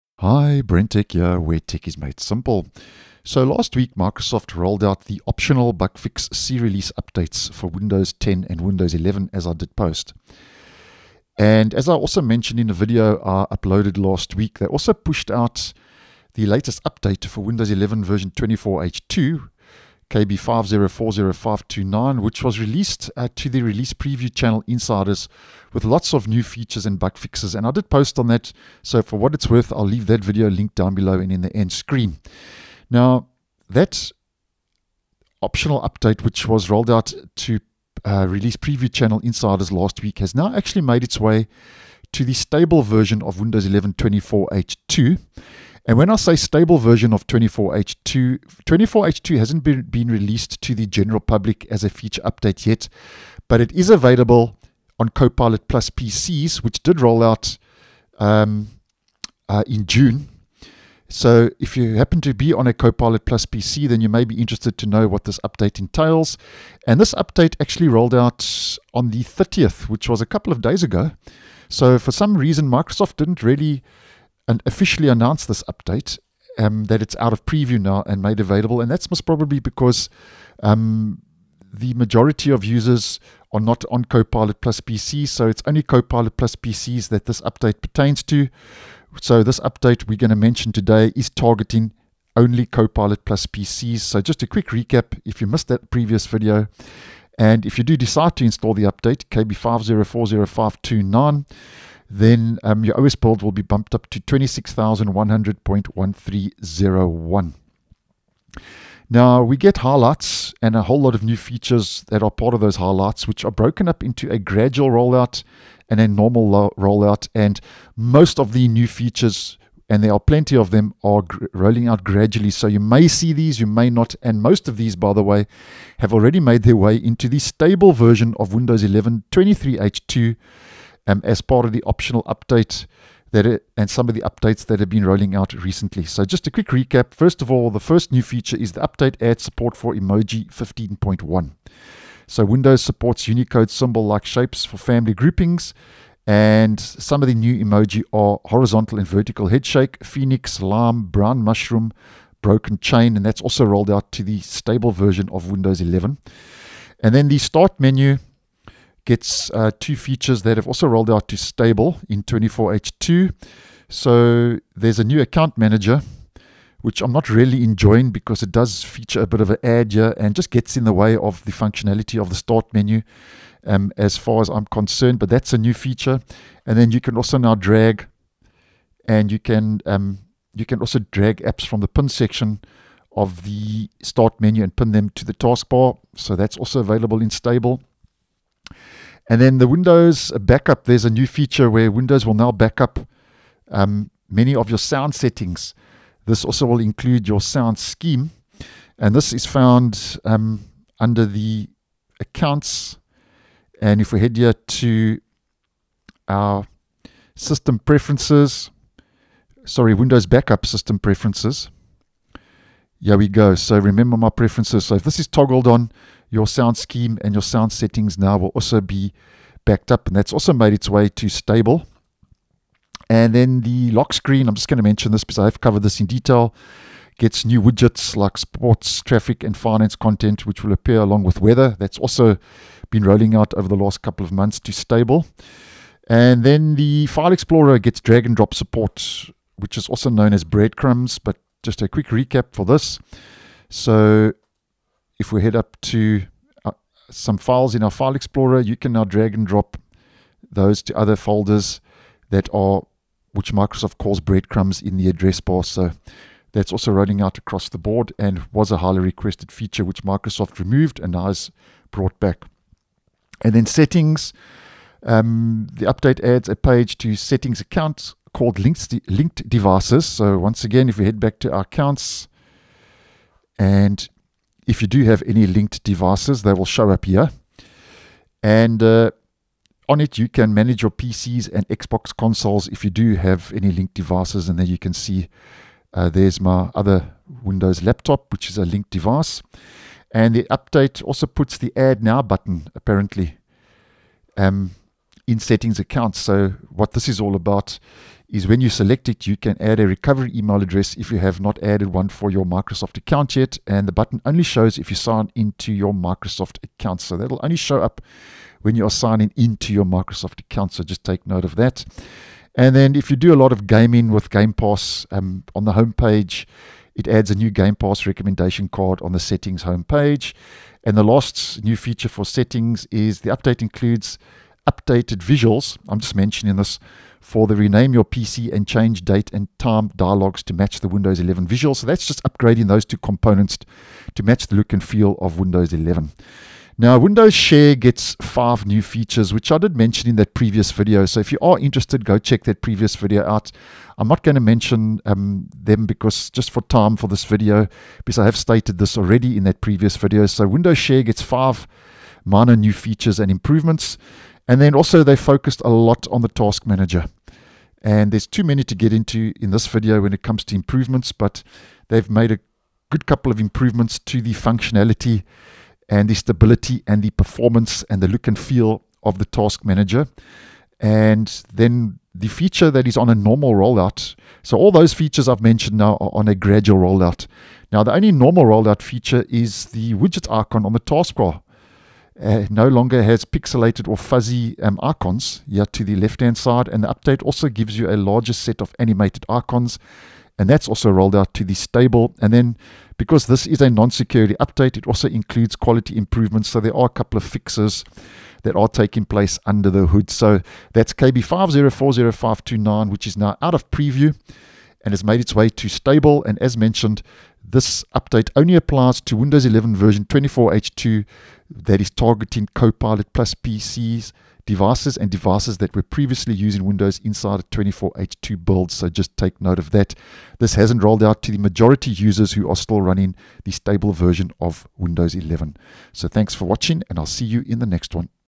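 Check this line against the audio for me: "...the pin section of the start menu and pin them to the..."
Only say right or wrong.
right.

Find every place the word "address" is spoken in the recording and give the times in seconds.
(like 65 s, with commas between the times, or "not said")
255 s, 300 s.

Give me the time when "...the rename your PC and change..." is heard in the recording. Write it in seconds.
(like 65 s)
327 s.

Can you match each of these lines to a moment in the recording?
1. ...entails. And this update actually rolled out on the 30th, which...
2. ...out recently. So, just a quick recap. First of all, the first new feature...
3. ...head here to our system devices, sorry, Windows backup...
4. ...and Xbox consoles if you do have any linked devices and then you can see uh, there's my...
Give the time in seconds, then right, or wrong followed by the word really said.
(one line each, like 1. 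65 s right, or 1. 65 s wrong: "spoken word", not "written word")
1. 65 s right
2. 135 s right
3. 204 s wrong: "preferences", not "devices"
4. 281 s right.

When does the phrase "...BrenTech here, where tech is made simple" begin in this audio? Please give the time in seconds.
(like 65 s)
0 s.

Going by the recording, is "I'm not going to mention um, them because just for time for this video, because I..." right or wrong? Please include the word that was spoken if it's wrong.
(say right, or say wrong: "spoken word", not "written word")
right.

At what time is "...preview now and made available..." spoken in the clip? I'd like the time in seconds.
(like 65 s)
77 s.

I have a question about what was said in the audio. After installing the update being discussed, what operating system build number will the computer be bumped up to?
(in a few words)
26100.1301.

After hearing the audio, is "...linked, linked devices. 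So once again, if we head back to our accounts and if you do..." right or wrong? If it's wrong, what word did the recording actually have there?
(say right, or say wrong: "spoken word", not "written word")
right.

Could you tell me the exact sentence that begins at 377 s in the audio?
Now, the only normal rollout feature is the widget icon on the taskbar.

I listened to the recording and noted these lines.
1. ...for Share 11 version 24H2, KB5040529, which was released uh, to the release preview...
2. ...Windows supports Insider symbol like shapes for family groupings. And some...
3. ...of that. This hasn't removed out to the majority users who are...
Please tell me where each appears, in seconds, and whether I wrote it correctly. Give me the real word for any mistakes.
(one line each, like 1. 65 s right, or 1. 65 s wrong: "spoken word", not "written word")
1. 17 s wrong: "Windows", not "Share"
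2. 142 s wrong: "Unicode", not "Insider"
3. 419 s wrong: "rolled", not "removed".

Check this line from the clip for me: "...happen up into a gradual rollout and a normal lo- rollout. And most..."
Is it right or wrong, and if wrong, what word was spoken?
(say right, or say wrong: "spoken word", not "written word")
wrong: "broken", not "happen".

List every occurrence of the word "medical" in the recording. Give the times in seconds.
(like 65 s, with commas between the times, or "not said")
not said.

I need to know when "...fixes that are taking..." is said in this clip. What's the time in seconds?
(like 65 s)
397 s.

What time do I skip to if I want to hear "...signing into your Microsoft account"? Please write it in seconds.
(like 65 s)
308 s.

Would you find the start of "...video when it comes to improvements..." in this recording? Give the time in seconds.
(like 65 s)
359 s.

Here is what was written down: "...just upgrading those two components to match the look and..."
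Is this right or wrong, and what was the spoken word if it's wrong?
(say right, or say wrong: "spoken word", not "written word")
right.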